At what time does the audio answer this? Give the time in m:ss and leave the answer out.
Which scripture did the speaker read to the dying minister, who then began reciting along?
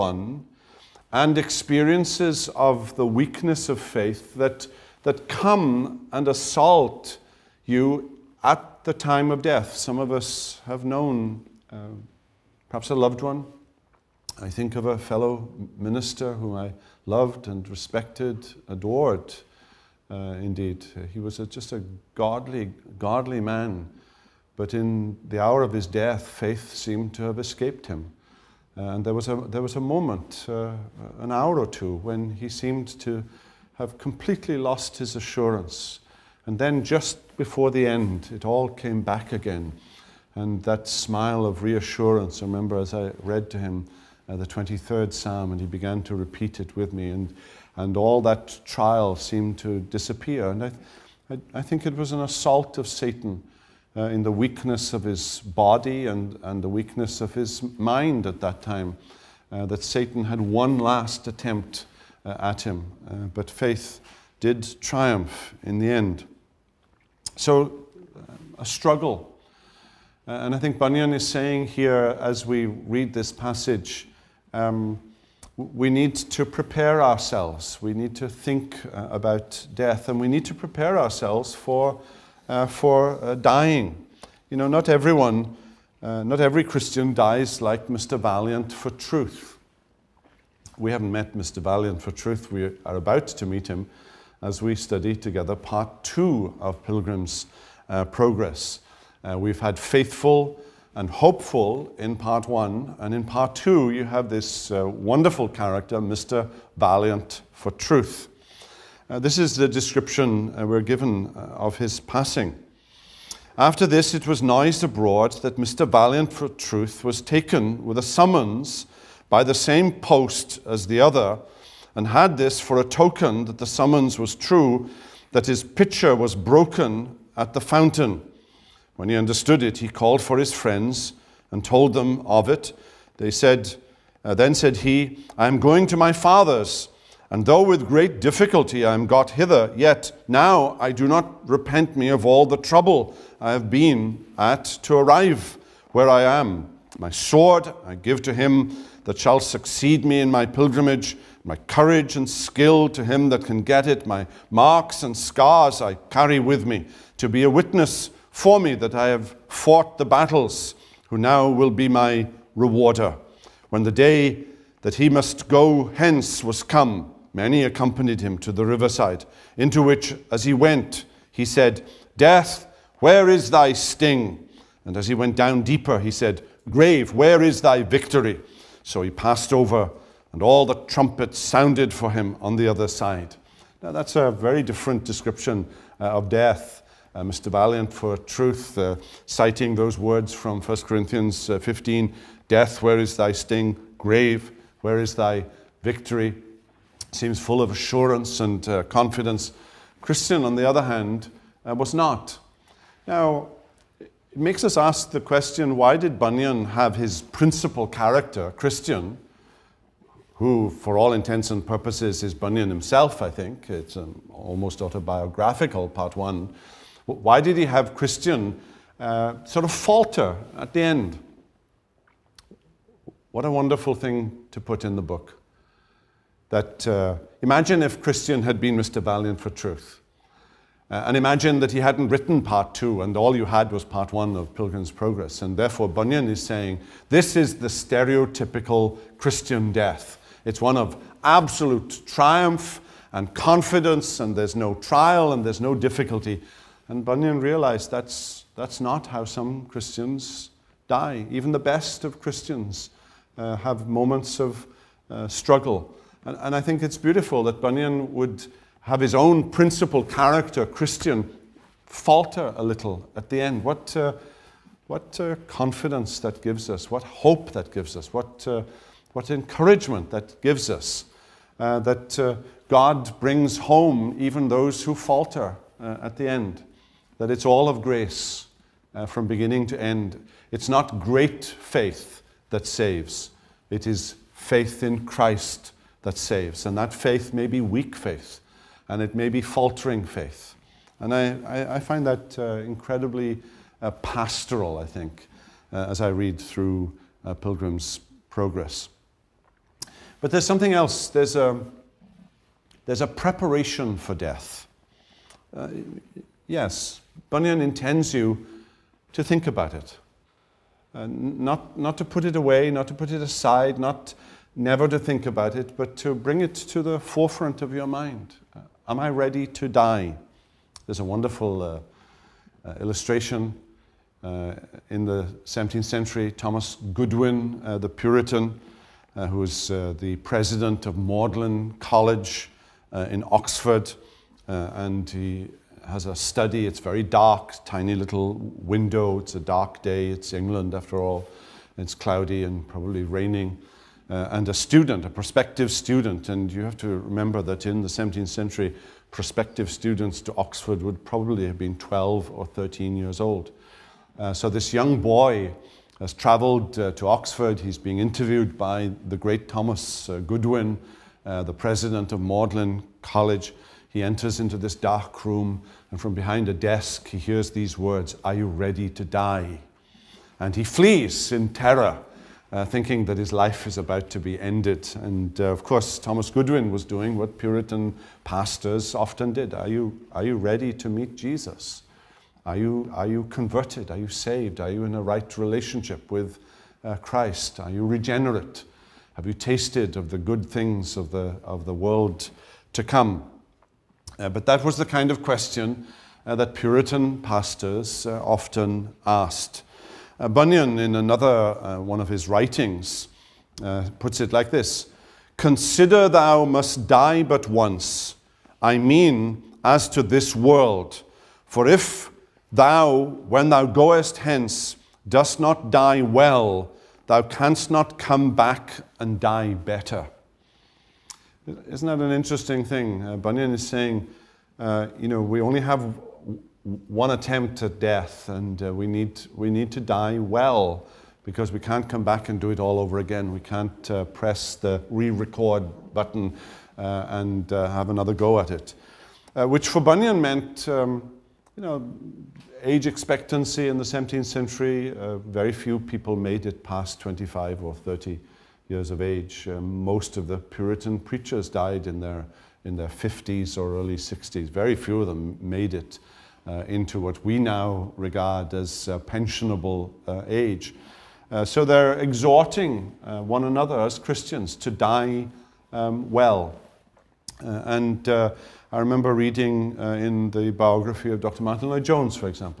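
0:44.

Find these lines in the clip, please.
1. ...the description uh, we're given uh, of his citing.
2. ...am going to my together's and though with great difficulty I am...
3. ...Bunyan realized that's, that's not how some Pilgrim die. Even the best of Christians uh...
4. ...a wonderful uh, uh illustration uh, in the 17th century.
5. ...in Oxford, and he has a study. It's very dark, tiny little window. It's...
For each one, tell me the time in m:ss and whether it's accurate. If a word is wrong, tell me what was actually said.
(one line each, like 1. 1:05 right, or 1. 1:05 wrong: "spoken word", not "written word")
1. 1:49 wrong: "passing", not "citing"
2. 2:15 wrong: "father", not "together"
3. 4:07 wrong: "Christians", not "Pilgrim"
4. 5:21 right
5. 5:33 right.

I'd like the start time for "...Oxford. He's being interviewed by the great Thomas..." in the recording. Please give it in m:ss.
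5:57.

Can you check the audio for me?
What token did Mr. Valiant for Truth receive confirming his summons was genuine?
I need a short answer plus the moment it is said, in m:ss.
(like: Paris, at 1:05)
His pitcher was broken at the fountain, at 2:05.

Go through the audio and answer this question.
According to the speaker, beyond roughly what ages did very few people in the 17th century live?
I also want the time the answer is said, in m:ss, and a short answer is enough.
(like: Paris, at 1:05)
25 or 30, at 7:27.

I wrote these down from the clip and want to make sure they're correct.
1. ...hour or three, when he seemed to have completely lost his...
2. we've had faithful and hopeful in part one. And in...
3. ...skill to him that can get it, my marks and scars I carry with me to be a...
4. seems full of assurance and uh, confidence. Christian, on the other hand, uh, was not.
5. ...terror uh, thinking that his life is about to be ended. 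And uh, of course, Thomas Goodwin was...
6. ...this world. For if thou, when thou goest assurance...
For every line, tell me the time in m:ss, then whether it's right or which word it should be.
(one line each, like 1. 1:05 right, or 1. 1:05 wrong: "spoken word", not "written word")
1. 0:31 wrong: "two", not "three"
2. 1:39 right
3. 2:32 right
4. 3:17 right
5. 6:11 right
6. 6:50 wrong: "hence", not "assurance".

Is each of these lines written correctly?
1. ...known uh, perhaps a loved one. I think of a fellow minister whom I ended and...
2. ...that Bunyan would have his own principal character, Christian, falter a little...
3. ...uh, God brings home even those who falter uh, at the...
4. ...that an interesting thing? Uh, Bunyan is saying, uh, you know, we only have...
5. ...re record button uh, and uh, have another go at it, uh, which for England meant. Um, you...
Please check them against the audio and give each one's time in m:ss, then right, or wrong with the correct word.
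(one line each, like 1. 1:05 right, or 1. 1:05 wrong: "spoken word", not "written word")
1. 0:10 wrong: "loved", not "ended"
2. 4:17 right
3. 4:32 right
4. 7:01 right
5. 7:14 wrong: "Bunyan", not "England".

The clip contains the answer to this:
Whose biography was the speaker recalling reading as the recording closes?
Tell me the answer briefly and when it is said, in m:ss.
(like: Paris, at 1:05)
Dr. Martyn Lloyd Jones, at 7:51.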